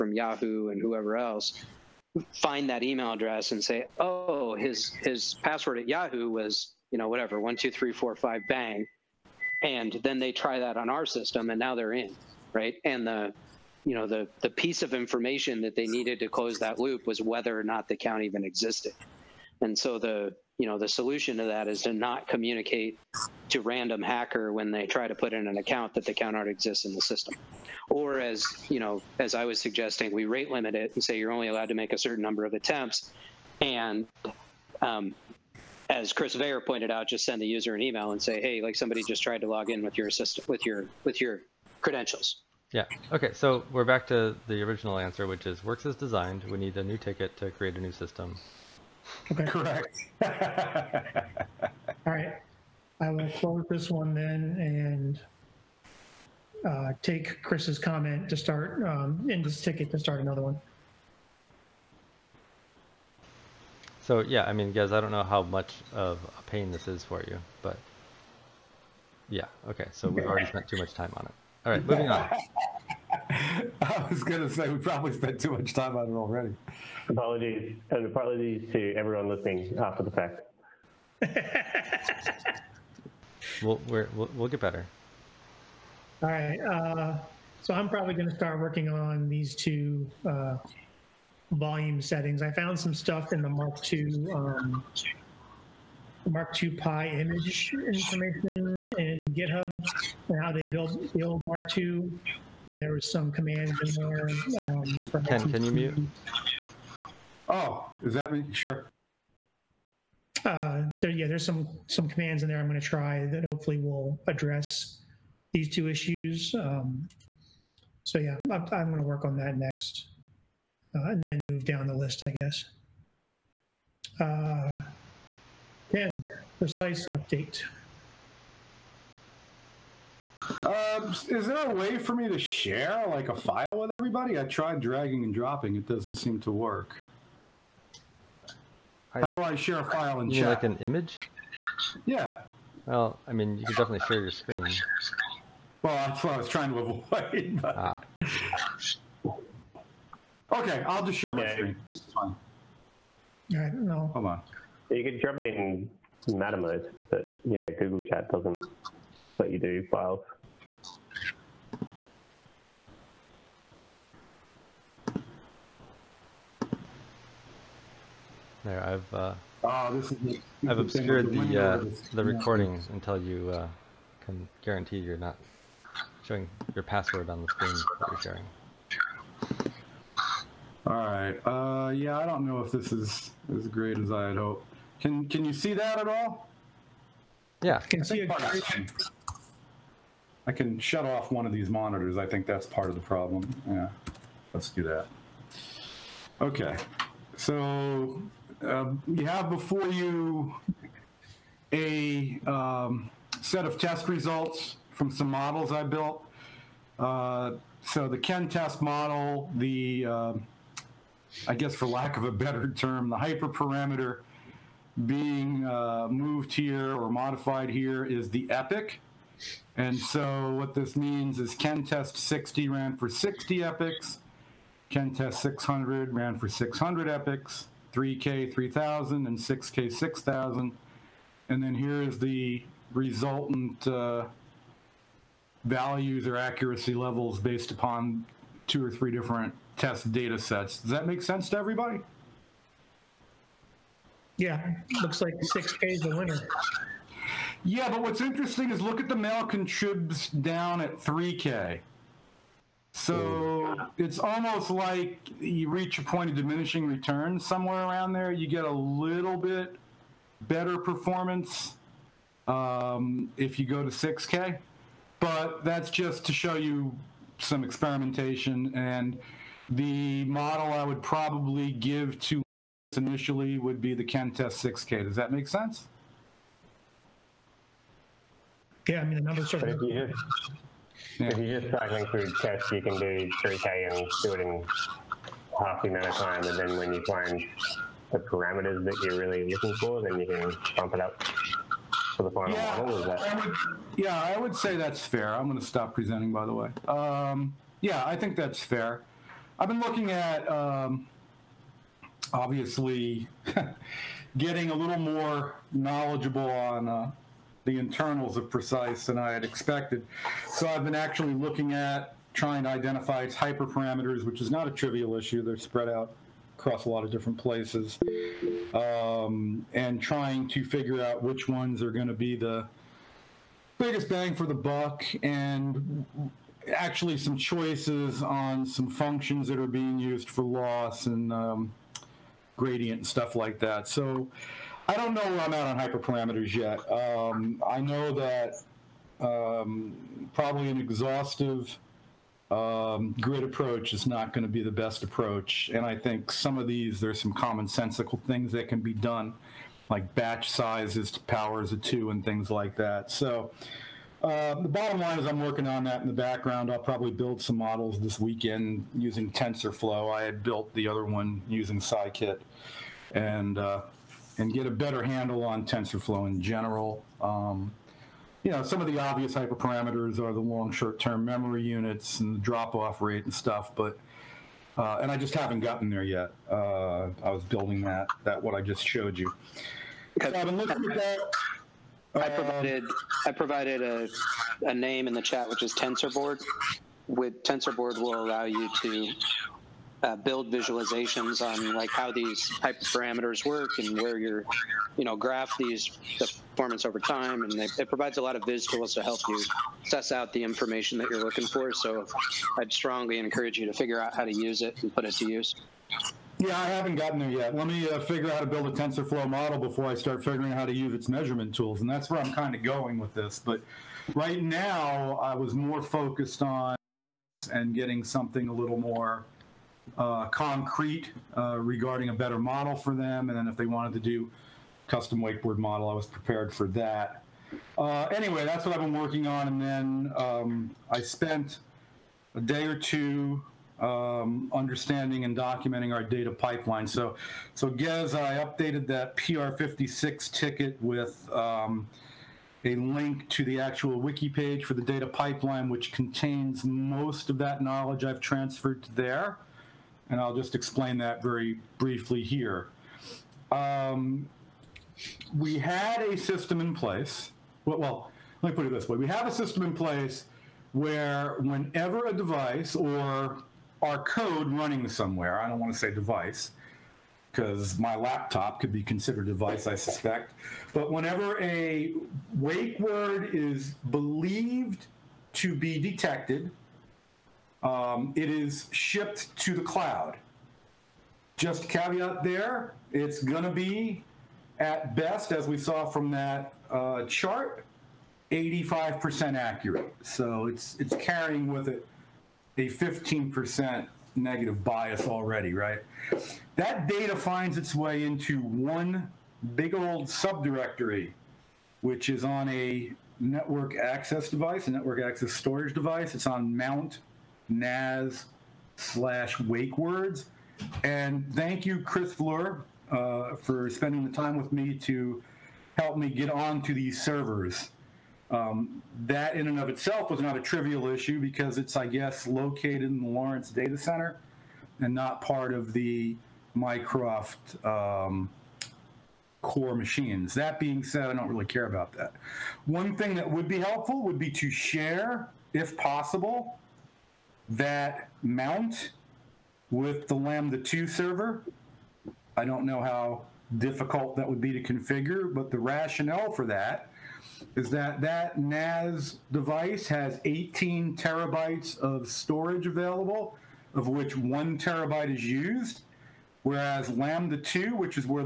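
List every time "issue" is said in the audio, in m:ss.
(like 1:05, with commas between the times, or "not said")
1:55, 5:15, 8:40.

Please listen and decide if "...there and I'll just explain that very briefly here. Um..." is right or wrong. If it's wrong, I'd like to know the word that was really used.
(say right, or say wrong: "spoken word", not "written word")
right.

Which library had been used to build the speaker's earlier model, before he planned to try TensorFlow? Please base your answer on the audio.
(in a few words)
Scikit.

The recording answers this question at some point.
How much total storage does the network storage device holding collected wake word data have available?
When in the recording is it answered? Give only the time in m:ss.
9:10.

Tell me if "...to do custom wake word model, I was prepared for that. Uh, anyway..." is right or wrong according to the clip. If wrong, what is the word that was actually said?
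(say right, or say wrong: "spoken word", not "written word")
right.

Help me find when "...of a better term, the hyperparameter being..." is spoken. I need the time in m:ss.
3:32.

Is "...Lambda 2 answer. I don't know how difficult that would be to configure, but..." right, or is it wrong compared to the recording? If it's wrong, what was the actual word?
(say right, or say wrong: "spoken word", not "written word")
wrong: "server", not "answer".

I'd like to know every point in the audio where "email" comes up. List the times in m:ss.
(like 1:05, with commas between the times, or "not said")
0:02, 0:37.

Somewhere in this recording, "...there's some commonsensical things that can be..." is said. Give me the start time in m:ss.
5:46.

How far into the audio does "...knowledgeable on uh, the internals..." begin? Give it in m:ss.
5:05.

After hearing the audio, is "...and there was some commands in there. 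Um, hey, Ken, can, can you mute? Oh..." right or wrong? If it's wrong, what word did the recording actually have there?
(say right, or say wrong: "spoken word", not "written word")
right.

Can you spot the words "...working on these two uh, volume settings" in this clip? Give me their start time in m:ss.
1:28.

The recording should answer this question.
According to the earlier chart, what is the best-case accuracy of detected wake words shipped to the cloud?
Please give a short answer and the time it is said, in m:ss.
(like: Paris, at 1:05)
85%, at 8:08.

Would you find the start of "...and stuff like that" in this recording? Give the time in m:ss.
5:32.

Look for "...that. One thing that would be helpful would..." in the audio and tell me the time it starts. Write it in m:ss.
8:51.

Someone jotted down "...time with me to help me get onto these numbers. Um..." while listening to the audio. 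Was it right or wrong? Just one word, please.
wrong.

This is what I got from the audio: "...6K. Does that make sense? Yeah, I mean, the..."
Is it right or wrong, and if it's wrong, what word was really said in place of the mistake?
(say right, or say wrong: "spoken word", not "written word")
right.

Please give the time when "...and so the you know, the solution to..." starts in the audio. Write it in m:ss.
0:19.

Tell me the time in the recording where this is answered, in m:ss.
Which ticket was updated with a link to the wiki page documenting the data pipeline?
7:19.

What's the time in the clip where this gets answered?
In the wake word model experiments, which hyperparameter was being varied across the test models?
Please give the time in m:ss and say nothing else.
3:38.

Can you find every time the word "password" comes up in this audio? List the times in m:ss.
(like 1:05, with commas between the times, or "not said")
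0:05, 2:56.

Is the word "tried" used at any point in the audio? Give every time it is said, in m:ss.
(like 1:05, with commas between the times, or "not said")
0:39, 2:14.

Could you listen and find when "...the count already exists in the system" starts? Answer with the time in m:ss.
0:26.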